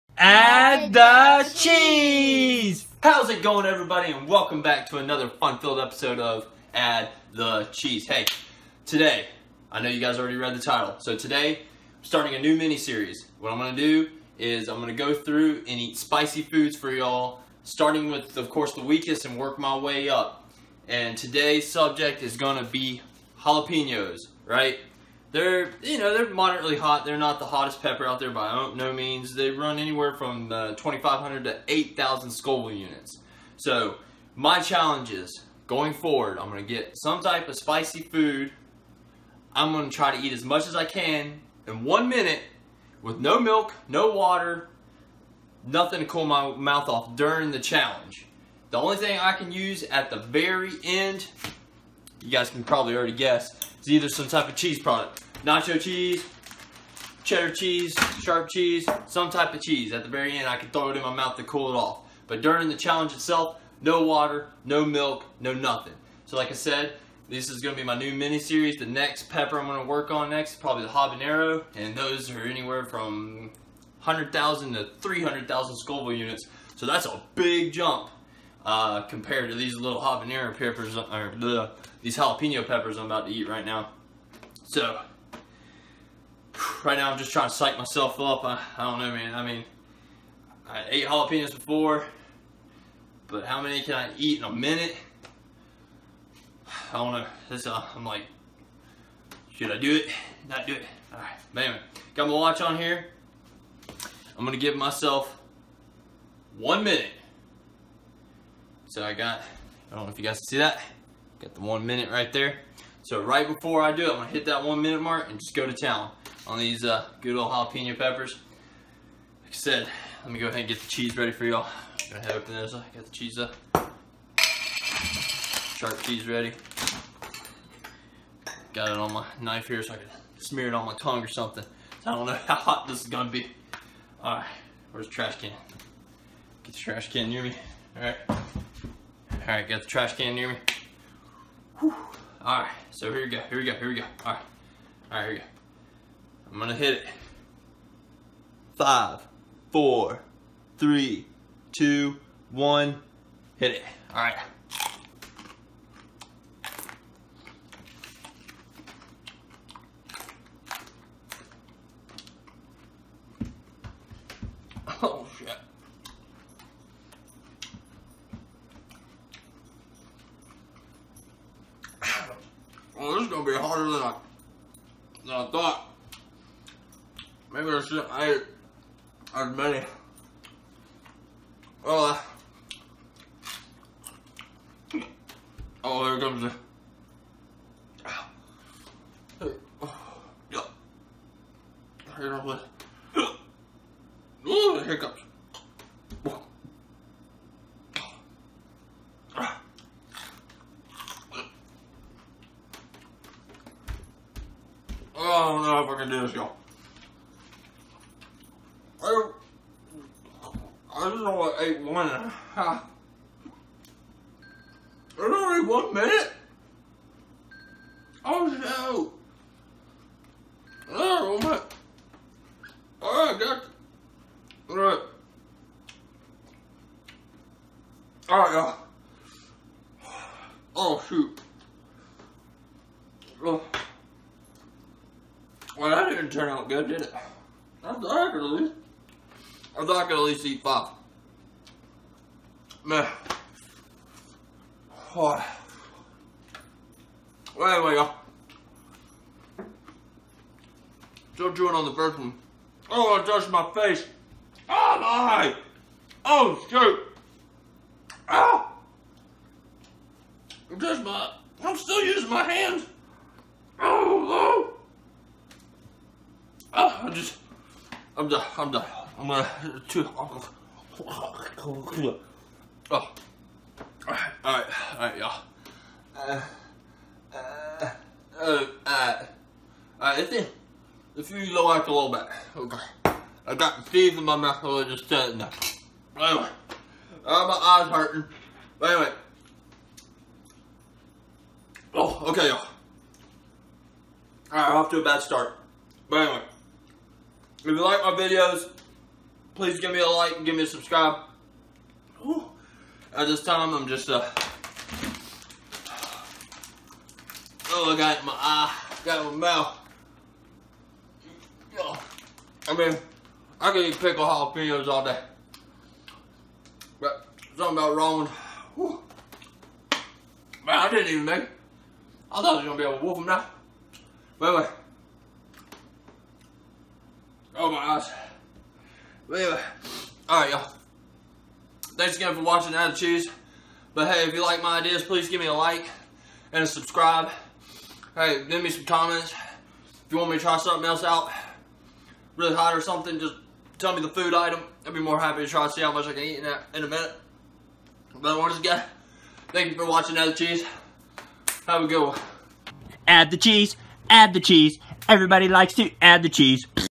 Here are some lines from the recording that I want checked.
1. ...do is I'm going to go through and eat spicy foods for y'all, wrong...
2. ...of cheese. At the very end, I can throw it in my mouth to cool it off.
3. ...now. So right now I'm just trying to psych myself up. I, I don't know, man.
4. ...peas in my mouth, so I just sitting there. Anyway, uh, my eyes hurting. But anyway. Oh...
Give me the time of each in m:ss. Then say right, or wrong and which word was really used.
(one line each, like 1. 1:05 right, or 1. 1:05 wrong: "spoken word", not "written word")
1. 0:13 wrong: "starting", not "wrong"
2. 0:59 right
3. 1:23 right
4. 4:43 right.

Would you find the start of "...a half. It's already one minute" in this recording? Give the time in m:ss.
3:32.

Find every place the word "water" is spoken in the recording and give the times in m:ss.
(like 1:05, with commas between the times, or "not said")
0:44, 1:04.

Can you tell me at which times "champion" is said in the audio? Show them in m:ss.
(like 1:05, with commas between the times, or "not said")
not said.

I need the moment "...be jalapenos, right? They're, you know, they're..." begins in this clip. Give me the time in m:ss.
0:22.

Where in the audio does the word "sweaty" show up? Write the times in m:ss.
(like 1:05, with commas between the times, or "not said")
not said.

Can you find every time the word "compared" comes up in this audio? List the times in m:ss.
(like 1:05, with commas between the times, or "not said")
1:19.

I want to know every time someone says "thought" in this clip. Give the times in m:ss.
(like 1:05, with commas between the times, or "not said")
2:55, 5:22.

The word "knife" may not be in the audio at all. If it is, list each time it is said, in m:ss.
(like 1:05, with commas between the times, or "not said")
2:09.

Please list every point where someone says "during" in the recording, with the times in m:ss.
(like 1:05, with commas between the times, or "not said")
0:47, 1:02.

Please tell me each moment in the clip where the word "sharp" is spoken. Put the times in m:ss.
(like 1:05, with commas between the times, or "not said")
0:58, 2:05.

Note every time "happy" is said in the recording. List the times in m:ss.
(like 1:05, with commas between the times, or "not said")
5:45.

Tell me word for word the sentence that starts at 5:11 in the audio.
Yo, I mean, I can eat pickle jalapenos all day.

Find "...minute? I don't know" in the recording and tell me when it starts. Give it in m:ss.
1:34.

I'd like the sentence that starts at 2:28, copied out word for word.
Five, four, three, two, one, hit it.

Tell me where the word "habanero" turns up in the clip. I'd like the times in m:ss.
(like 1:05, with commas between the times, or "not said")
1:10, 1:20.